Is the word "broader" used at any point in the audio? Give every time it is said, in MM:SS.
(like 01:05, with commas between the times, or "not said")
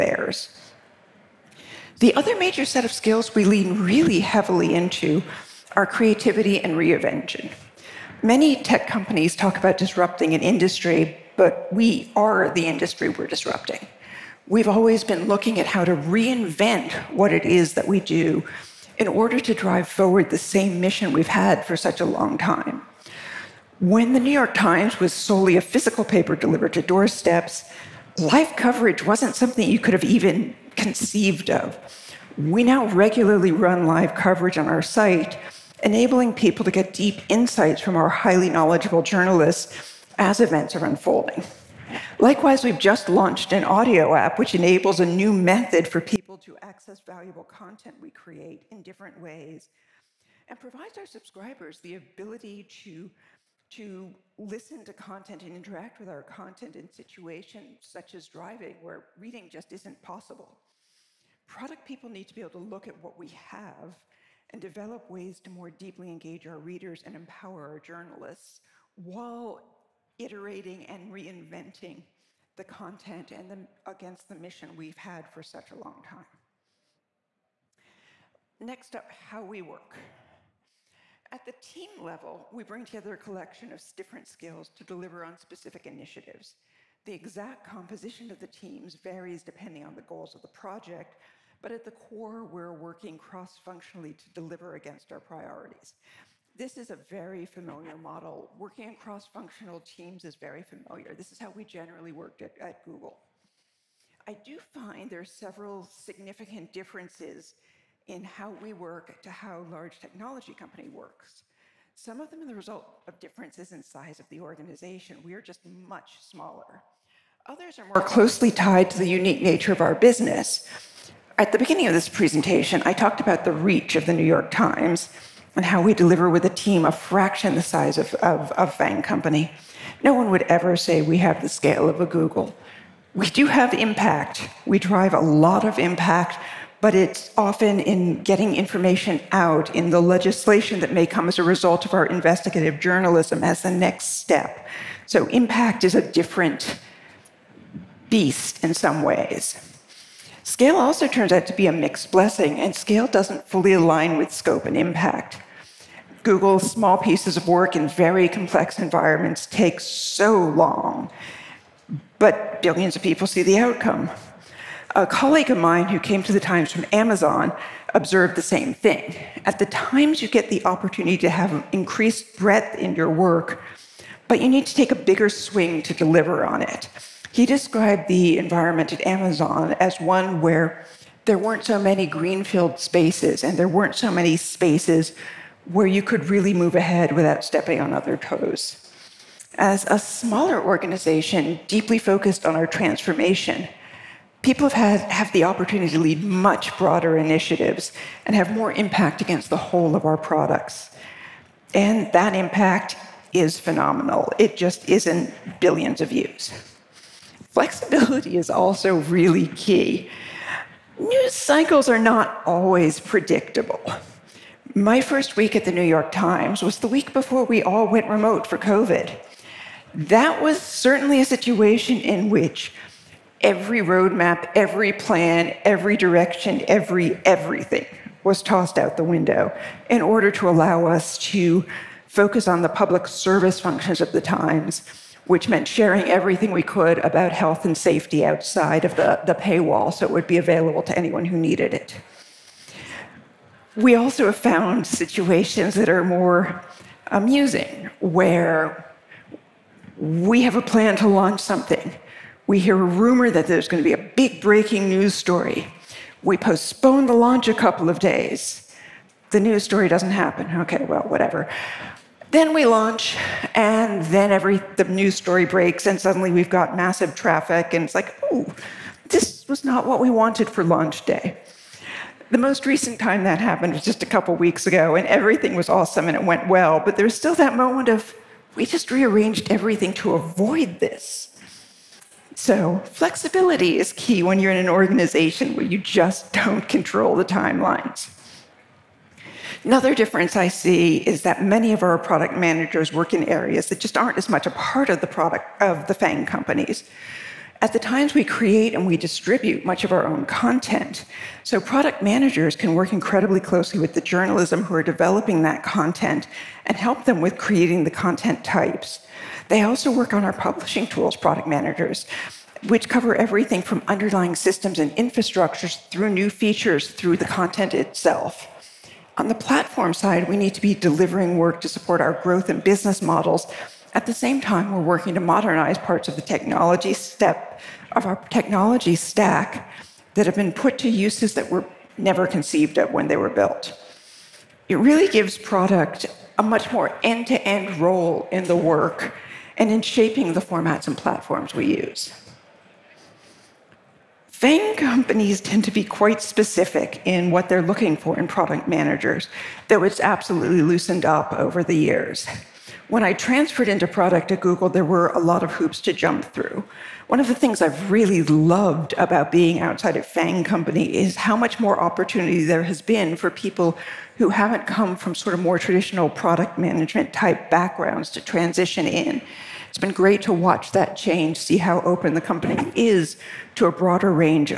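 03:16, 06:13.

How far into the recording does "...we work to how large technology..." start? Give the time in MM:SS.
01:48.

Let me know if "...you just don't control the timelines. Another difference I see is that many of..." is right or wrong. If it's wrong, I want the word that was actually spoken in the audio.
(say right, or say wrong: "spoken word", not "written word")
right.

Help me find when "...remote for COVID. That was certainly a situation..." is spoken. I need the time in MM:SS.
03:38.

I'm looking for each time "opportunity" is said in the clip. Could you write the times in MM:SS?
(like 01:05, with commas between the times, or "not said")
02:50, 03:15, 06:01.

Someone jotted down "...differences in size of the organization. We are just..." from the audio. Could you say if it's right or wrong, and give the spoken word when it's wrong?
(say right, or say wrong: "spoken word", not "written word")
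right.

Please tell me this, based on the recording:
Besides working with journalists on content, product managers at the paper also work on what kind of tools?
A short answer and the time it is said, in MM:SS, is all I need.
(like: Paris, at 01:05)
publishing tools, at 05:10.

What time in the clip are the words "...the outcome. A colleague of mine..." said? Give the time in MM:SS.
02:43.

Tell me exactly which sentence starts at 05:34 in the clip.
It really gives product a much more end-to-end role in the work and in shaping the formats and platforms we use.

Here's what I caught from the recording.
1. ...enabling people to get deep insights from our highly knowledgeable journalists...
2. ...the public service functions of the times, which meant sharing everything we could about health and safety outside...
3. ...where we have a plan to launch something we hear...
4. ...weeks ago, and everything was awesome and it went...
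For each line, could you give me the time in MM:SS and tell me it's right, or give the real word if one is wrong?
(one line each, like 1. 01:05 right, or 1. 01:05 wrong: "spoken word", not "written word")
1. 00:35 right
2. 03:52 right
3. 04:07 right
4. 04:34 right.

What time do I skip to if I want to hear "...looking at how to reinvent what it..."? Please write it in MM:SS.
00:15.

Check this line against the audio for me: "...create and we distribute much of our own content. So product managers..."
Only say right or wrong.
right.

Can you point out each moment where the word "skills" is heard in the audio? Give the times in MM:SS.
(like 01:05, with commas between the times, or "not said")
00:02, 01:24.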